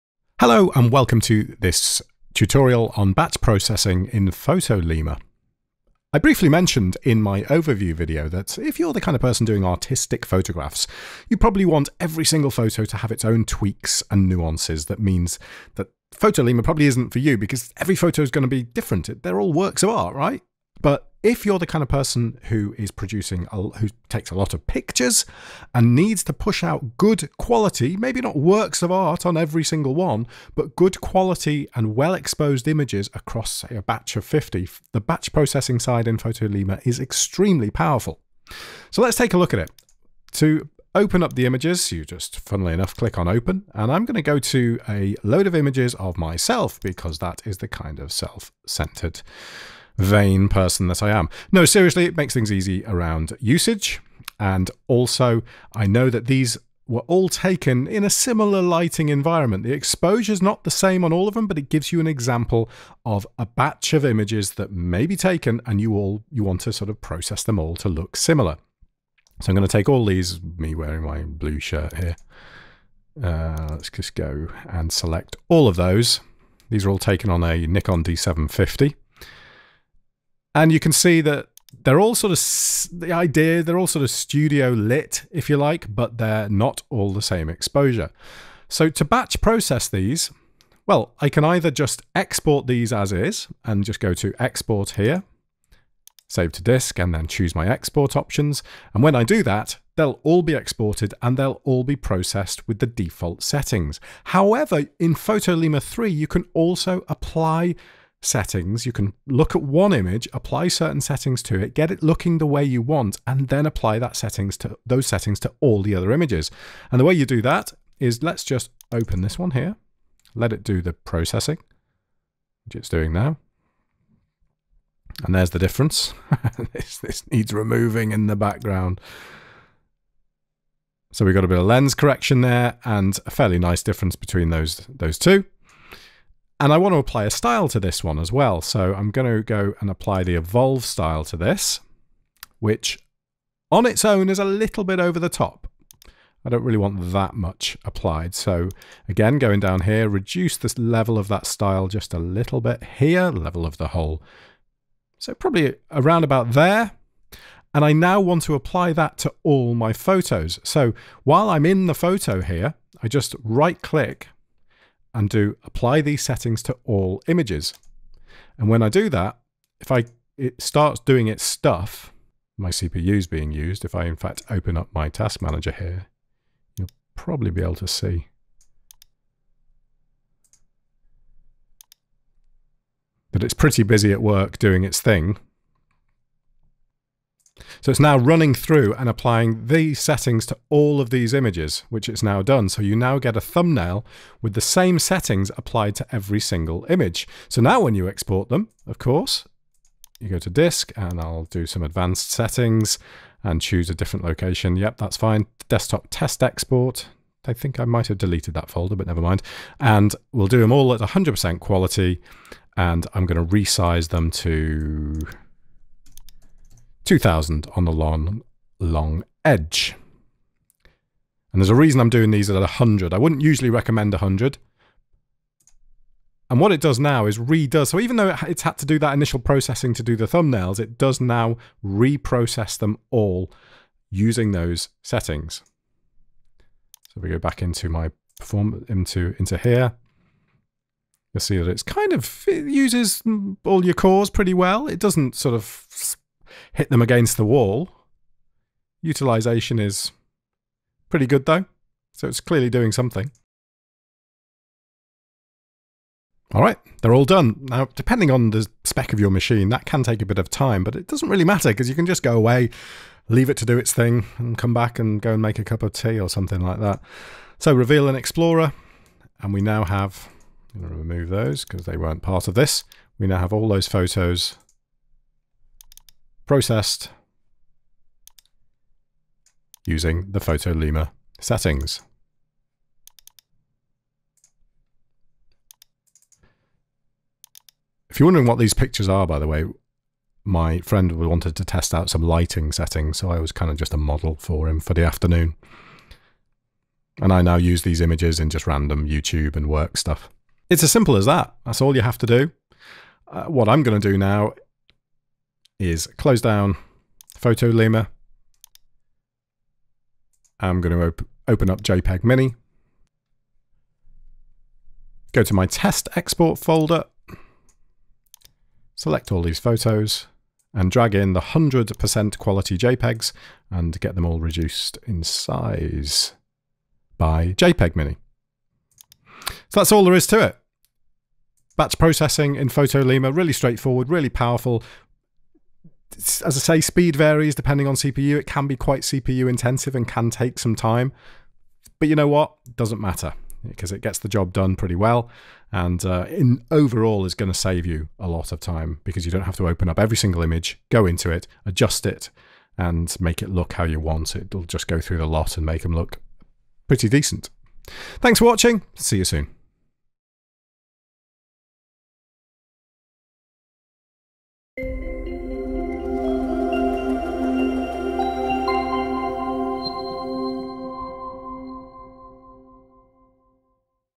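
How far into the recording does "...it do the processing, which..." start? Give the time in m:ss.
2:00.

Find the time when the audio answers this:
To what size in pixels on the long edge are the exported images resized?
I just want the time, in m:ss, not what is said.
3:37.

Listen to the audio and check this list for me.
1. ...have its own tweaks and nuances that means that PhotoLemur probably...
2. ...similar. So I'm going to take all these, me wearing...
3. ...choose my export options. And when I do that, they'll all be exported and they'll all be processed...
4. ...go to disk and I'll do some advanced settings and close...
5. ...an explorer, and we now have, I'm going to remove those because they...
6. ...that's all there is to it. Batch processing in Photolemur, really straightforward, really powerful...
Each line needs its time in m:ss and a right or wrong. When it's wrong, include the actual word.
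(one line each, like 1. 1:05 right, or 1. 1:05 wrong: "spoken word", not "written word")
1. 0:12 right
2. 1:08 right
3. 1:37 right
4. 3:20 wrong: "choose", not "close"
5. 4:28 right
6. 5:29 right.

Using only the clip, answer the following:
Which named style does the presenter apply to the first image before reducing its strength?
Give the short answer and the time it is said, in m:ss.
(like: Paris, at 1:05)
Evolve, at 2:20.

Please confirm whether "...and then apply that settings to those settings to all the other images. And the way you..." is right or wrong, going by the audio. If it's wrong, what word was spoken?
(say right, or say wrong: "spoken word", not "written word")
right.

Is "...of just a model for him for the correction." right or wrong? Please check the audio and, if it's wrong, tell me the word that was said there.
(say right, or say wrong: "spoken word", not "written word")
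wrong: "afternoon", not "correction".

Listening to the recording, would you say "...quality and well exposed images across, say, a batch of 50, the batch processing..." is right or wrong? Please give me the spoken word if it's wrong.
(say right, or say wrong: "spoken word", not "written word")
right.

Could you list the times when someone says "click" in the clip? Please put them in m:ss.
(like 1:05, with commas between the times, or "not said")
0:42, 2:43.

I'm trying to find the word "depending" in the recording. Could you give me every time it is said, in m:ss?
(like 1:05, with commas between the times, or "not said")
4:17, 5:37.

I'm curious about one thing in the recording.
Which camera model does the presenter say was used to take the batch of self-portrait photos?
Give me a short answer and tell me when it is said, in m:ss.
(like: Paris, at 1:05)
Nikon D750, at 1:17.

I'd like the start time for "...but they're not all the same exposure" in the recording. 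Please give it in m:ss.
1:25.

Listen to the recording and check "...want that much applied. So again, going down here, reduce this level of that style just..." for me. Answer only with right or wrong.
right.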